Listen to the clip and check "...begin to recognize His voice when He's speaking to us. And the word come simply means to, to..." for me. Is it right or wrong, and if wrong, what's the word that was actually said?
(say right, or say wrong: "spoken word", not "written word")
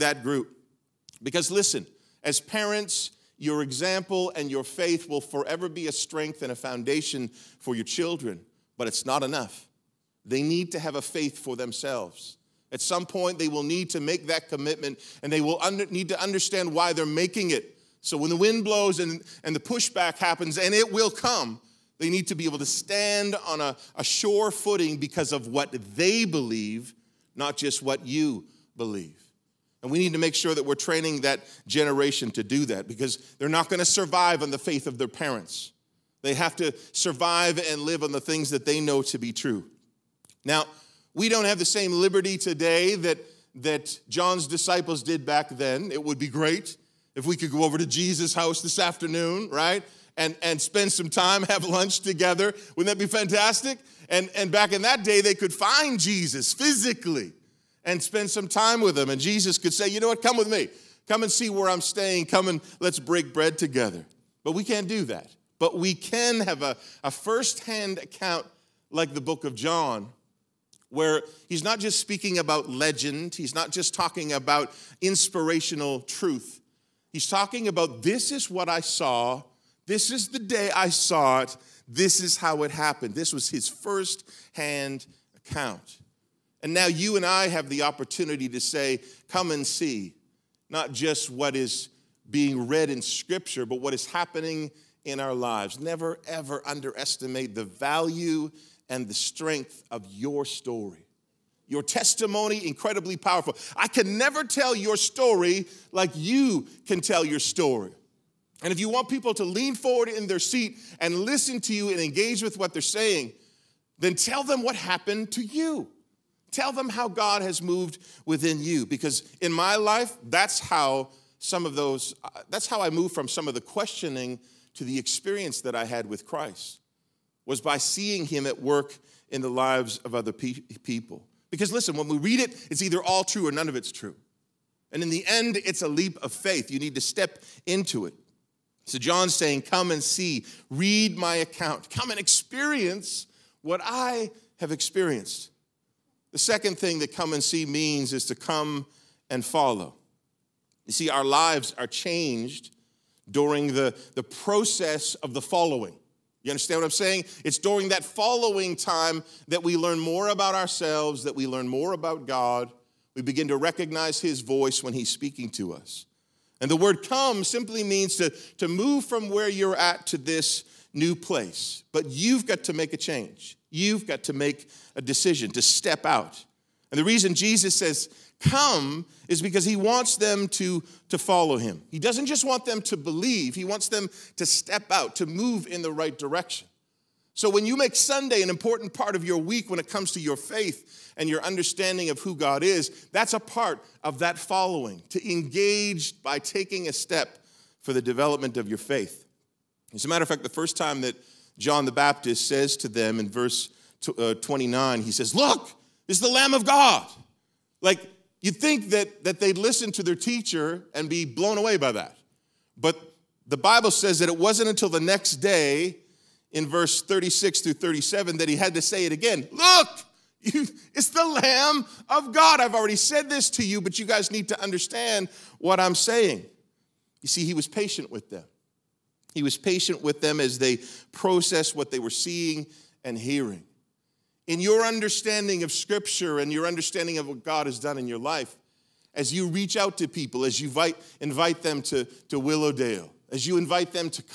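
right.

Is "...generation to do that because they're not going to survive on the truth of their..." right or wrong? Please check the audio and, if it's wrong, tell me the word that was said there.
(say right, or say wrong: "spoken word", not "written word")
wrong: "faith", not "truth".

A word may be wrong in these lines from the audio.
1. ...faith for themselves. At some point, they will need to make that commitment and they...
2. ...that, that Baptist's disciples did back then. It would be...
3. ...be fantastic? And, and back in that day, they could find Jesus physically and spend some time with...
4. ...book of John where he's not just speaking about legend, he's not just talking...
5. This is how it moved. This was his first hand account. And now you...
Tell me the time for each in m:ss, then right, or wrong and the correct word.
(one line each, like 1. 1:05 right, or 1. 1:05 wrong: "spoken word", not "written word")
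1. 0:11 right
2. 0:42 wrong: "John", not "Baptist"
3. 0:52 right
4. 1:09 right
5. 1:21 wrong: "happened", not "moved".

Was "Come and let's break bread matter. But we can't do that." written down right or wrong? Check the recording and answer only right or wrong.
wrong.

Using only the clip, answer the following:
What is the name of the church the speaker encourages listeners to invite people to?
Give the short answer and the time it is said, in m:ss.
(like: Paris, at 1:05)
Willowdale, at 4:02.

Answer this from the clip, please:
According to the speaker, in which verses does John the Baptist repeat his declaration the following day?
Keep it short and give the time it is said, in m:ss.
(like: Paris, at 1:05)
36 through 37, at 3:37.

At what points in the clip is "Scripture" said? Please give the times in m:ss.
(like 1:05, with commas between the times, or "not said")
1:33, 3:55.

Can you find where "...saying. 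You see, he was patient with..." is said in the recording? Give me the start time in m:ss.
3:45.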